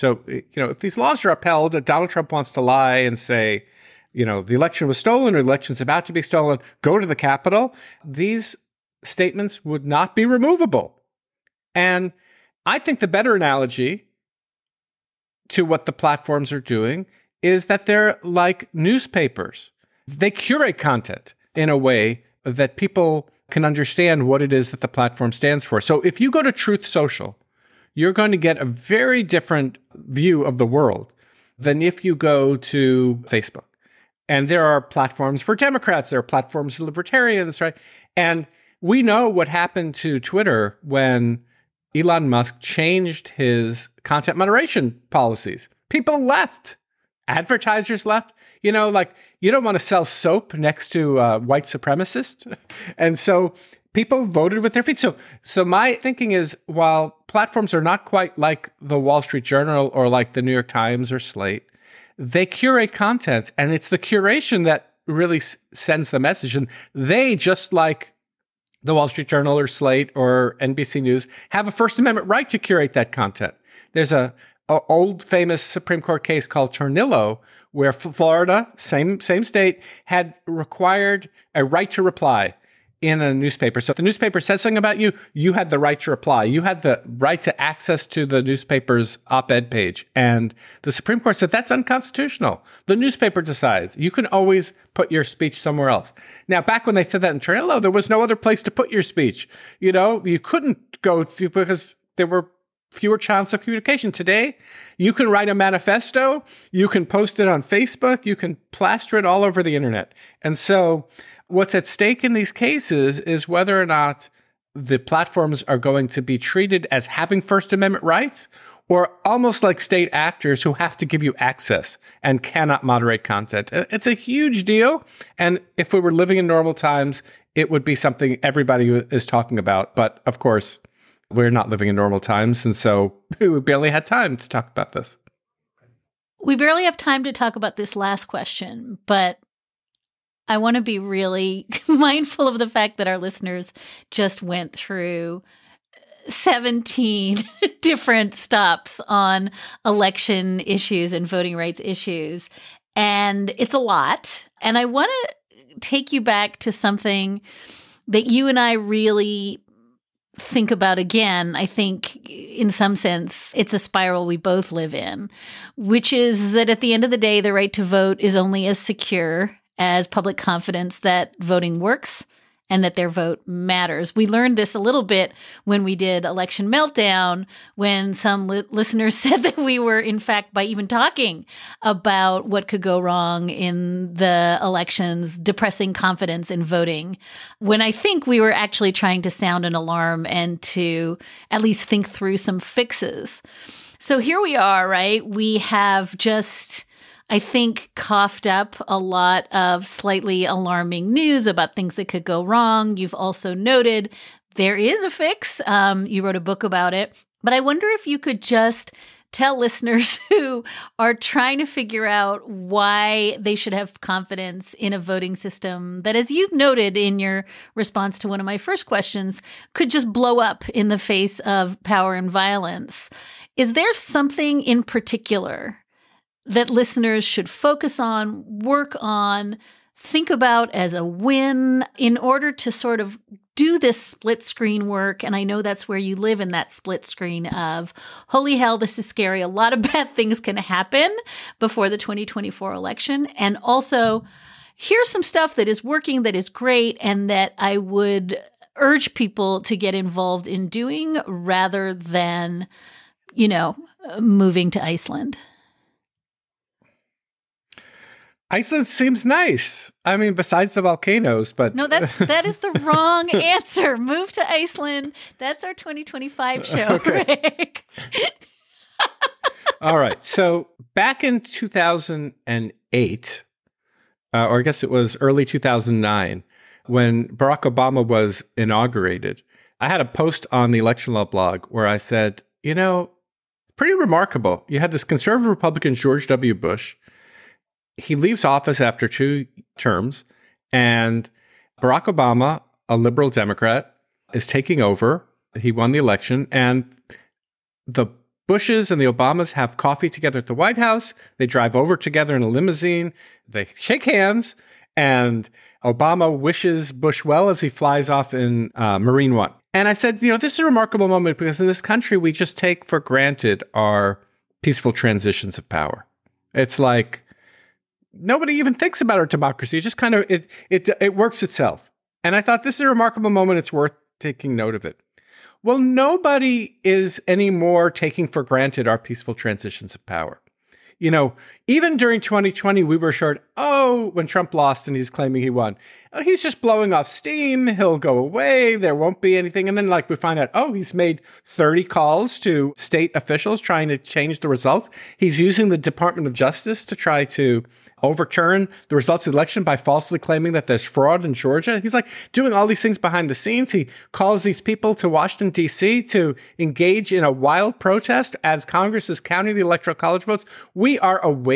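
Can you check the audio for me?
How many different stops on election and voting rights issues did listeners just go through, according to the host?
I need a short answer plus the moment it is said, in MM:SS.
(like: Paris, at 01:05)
17, at 02:26.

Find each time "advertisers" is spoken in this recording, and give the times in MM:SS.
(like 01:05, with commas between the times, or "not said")
00:47.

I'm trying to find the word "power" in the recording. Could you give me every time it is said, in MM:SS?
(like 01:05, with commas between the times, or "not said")
03:41, 05:15, 05:30.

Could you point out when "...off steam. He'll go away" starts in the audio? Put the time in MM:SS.
05:36.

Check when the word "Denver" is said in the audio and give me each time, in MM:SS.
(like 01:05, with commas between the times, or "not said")
not said.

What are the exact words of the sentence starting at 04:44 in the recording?
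You had this conservative Republican George W.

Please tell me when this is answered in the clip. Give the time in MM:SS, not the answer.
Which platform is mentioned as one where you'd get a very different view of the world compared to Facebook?
00:26.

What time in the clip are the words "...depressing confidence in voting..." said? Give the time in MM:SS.
03:05.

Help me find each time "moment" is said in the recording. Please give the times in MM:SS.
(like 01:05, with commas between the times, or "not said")
05:11, 05:23.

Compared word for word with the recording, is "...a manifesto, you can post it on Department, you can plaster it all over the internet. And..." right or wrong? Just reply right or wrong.
wrong.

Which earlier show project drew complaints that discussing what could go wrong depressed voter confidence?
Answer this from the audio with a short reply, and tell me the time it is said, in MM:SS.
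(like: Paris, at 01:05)
Election Meltdown, at 02:56.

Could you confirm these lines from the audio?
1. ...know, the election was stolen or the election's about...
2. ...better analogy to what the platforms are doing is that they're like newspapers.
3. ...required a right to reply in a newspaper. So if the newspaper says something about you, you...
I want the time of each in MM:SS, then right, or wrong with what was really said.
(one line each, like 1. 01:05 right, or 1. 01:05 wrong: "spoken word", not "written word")
1. 00:04 right
2. 00:13 right
3. 01:20 right.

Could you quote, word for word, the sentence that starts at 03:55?
And I know that's where you live in that split screen of holy hell, this is scary.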